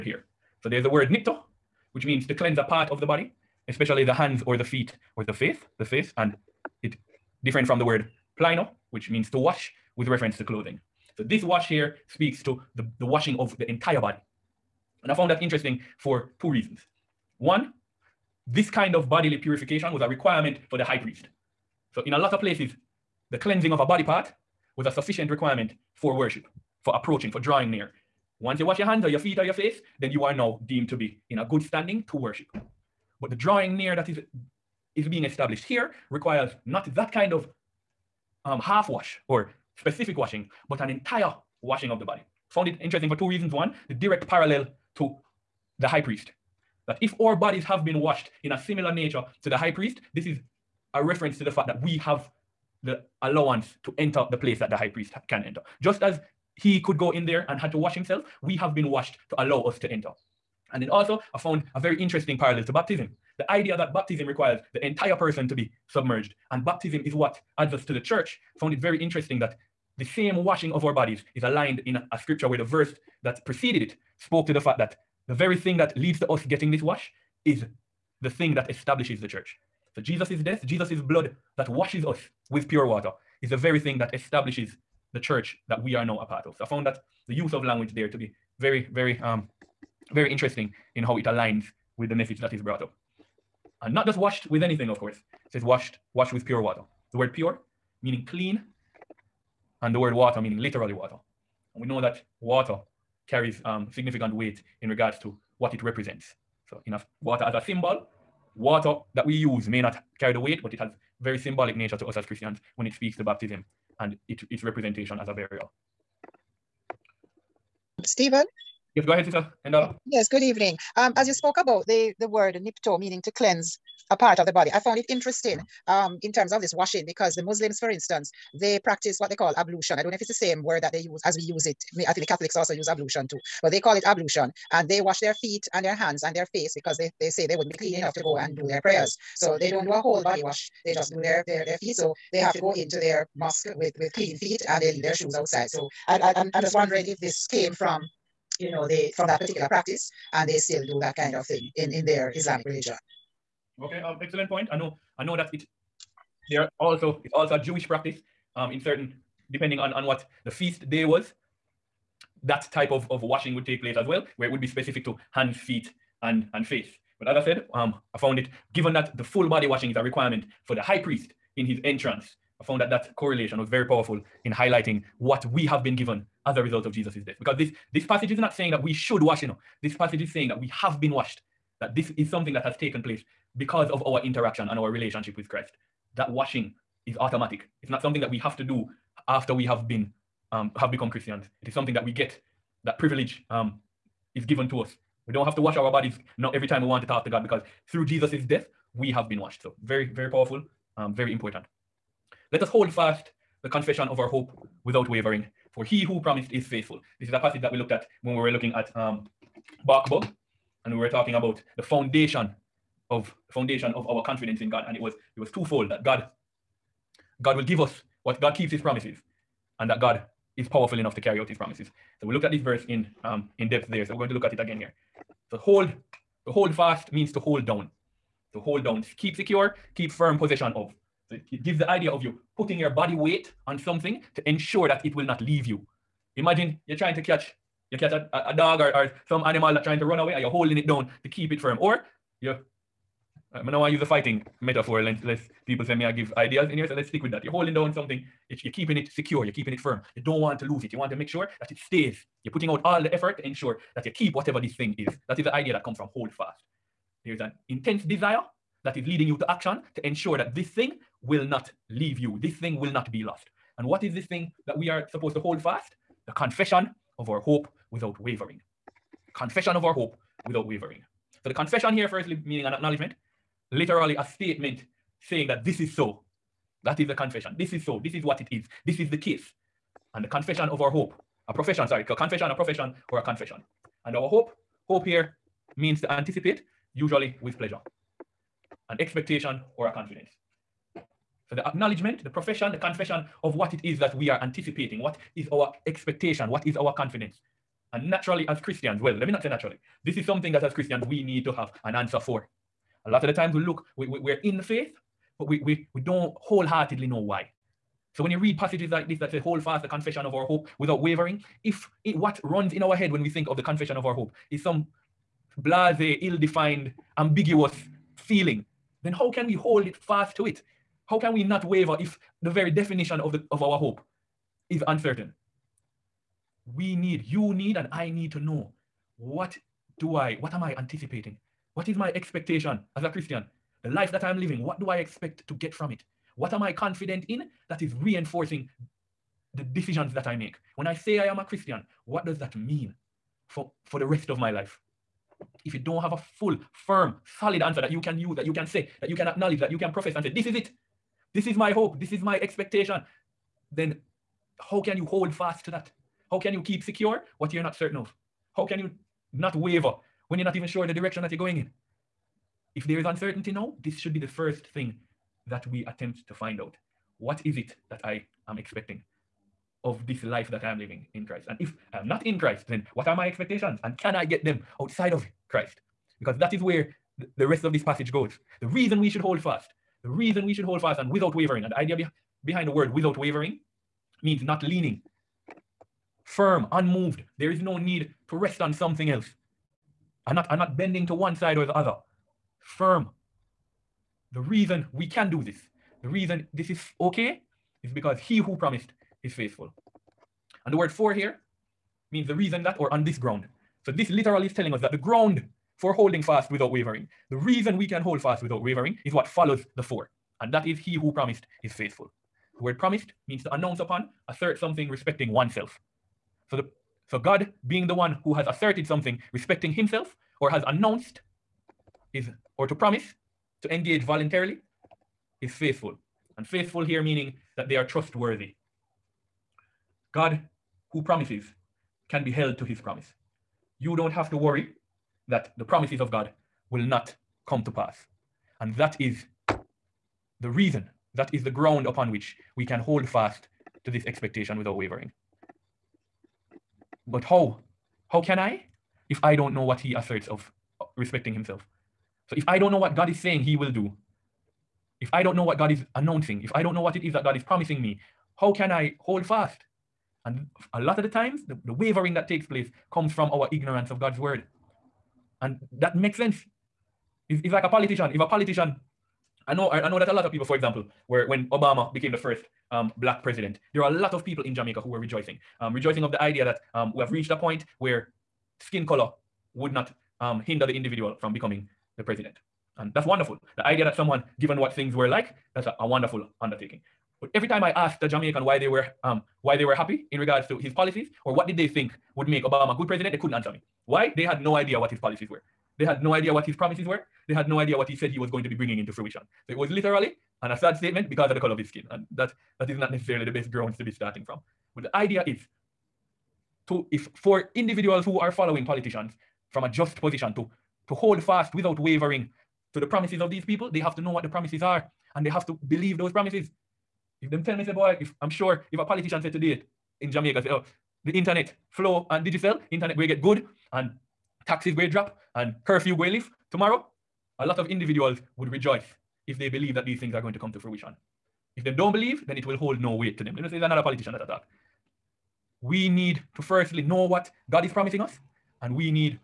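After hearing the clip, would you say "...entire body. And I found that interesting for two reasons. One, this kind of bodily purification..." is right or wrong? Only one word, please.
right.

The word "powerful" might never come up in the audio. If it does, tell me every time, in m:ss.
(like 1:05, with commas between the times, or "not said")
2:53, 3:20, 3:40.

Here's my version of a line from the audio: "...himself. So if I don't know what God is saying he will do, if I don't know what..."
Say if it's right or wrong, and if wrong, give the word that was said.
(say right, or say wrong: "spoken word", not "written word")
right.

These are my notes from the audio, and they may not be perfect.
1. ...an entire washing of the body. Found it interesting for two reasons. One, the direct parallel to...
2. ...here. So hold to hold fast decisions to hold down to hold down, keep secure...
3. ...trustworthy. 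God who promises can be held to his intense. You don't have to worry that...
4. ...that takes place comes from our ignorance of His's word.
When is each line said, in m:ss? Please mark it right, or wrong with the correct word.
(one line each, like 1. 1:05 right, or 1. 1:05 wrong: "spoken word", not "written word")
1. 0:40 right
2. 3:44 wrong: "means", not "decisions"
3. 7:07 wrong: "promise", not "intense"
4. 7:42 wrong: "God", not "His".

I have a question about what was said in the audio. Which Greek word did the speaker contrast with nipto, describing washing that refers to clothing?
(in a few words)
plino.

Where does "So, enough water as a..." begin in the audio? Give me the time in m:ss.
1:46.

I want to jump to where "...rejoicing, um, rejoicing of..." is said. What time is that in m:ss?
7:54.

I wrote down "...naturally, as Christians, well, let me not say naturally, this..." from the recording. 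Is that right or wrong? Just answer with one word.
right.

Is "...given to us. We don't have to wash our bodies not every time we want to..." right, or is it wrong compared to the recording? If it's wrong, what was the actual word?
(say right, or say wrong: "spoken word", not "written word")
right.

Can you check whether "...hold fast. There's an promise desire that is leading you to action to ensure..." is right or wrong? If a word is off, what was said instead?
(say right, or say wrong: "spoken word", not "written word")
wrong: "intense", not "promise".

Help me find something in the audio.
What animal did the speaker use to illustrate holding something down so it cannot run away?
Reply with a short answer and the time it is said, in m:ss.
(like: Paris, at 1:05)
a dog, at 3:58.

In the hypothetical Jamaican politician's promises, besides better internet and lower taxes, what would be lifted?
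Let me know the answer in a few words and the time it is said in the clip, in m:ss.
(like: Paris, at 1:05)
curfew, at 8:45.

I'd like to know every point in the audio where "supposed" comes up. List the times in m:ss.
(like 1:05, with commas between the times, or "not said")
4:25.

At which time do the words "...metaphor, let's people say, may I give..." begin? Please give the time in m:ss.
4:04.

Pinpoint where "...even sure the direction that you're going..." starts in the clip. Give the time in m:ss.
6:00.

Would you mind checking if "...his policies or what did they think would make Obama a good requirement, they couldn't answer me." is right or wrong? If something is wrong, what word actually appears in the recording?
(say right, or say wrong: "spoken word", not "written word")
wrong: "president", not "requirement".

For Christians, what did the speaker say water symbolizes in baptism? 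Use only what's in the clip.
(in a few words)
a burial.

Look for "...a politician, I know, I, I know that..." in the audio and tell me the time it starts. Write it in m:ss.
7:48.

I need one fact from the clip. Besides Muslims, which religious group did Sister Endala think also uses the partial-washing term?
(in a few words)
Catholics.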